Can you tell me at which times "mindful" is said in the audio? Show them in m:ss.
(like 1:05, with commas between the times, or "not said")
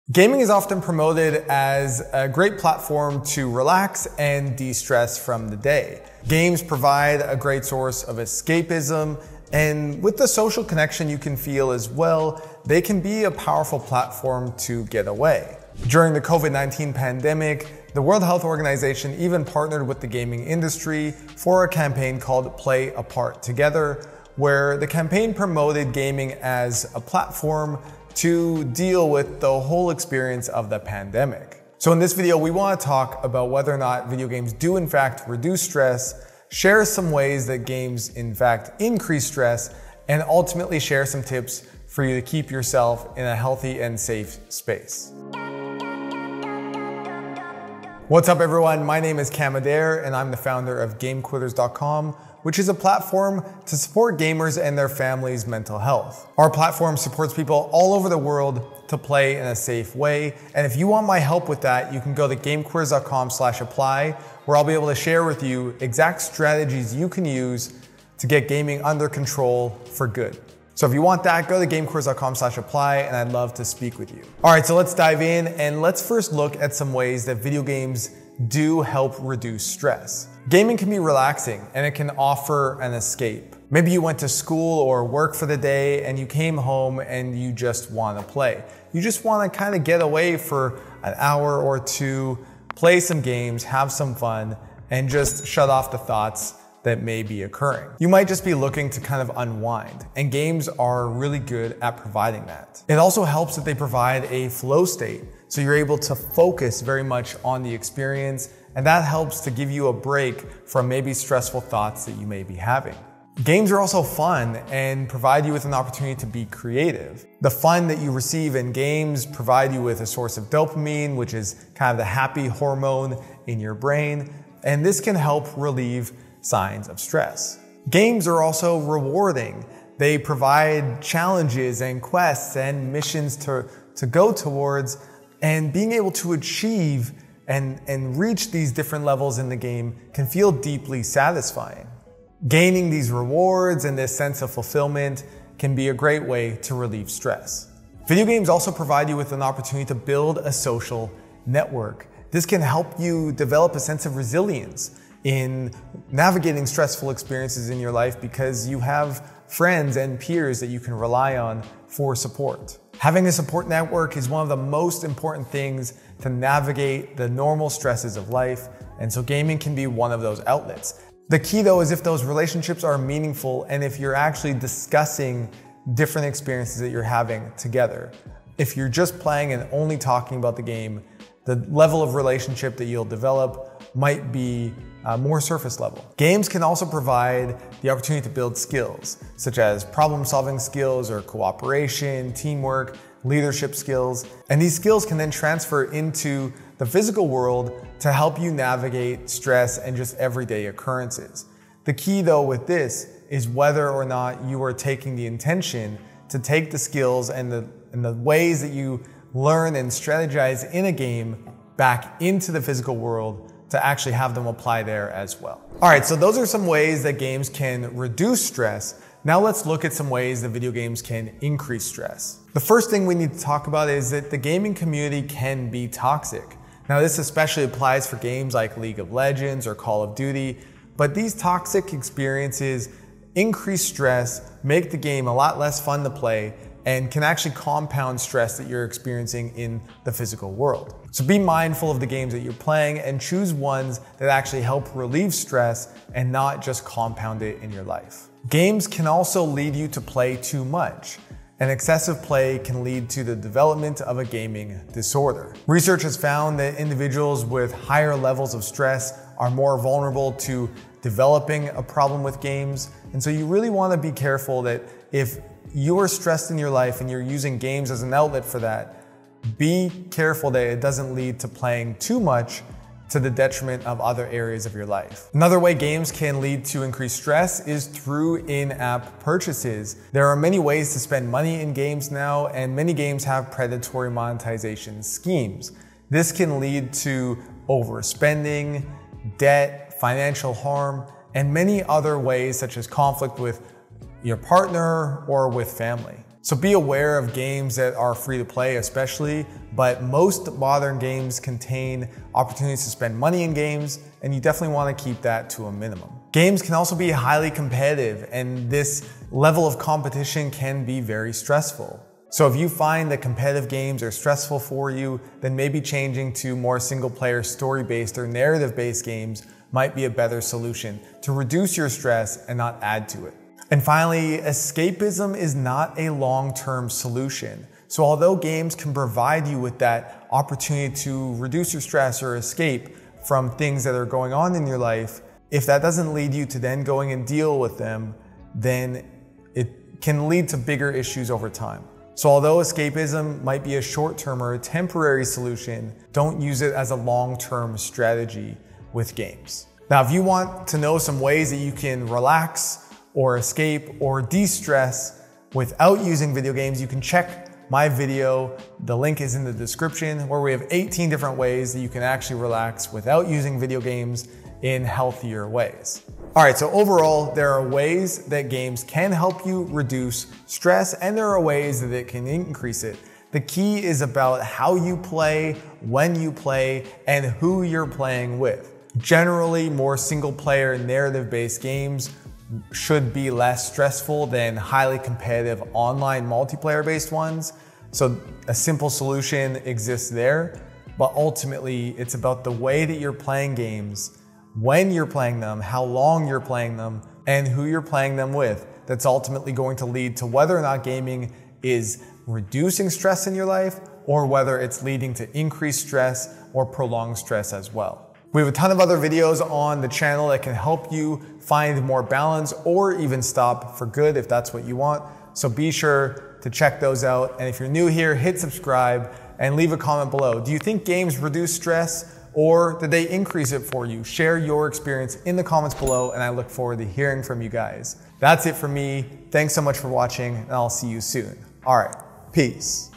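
4:01.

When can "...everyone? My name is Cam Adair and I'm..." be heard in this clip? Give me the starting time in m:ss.
0:48.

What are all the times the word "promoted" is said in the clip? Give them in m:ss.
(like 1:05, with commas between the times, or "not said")
0:00, 0:25.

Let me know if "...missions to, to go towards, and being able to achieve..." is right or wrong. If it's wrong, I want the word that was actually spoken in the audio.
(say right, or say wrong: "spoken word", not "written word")
right.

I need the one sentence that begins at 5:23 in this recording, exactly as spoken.
And finally, escapism is not a long term solution.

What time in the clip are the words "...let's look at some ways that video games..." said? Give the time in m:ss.
3:39.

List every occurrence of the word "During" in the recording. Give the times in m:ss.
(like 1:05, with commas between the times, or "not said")
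0:15.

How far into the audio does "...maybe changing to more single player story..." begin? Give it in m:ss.
5:15.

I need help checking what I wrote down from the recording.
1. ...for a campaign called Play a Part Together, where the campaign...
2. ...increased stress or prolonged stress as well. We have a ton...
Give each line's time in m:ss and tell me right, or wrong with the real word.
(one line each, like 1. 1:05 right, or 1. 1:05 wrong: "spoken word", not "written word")
1. 0:21 right
2. 6:45 right.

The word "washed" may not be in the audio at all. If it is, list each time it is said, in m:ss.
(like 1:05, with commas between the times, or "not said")
not said.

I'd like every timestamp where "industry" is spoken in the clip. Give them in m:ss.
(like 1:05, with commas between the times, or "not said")
0:20.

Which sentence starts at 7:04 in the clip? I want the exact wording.
Share your experience in the comments below and I look forward to hearing from you guys.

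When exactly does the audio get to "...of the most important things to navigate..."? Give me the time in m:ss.
2:44.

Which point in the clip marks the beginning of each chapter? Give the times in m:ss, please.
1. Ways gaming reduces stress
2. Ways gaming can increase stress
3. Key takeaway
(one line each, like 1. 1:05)
1. 1:15
2. 3:40
3. 6:07.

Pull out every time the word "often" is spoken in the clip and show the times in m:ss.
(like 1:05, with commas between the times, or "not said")
0:00.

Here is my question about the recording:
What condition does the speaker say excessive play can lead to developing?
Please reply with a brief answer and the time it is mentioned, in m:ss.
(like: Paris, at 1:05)
gaming disorder, at 4:14.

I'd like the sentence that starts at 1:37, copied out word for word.
You might just be looking to kind of unwind, and games are really good at providing that.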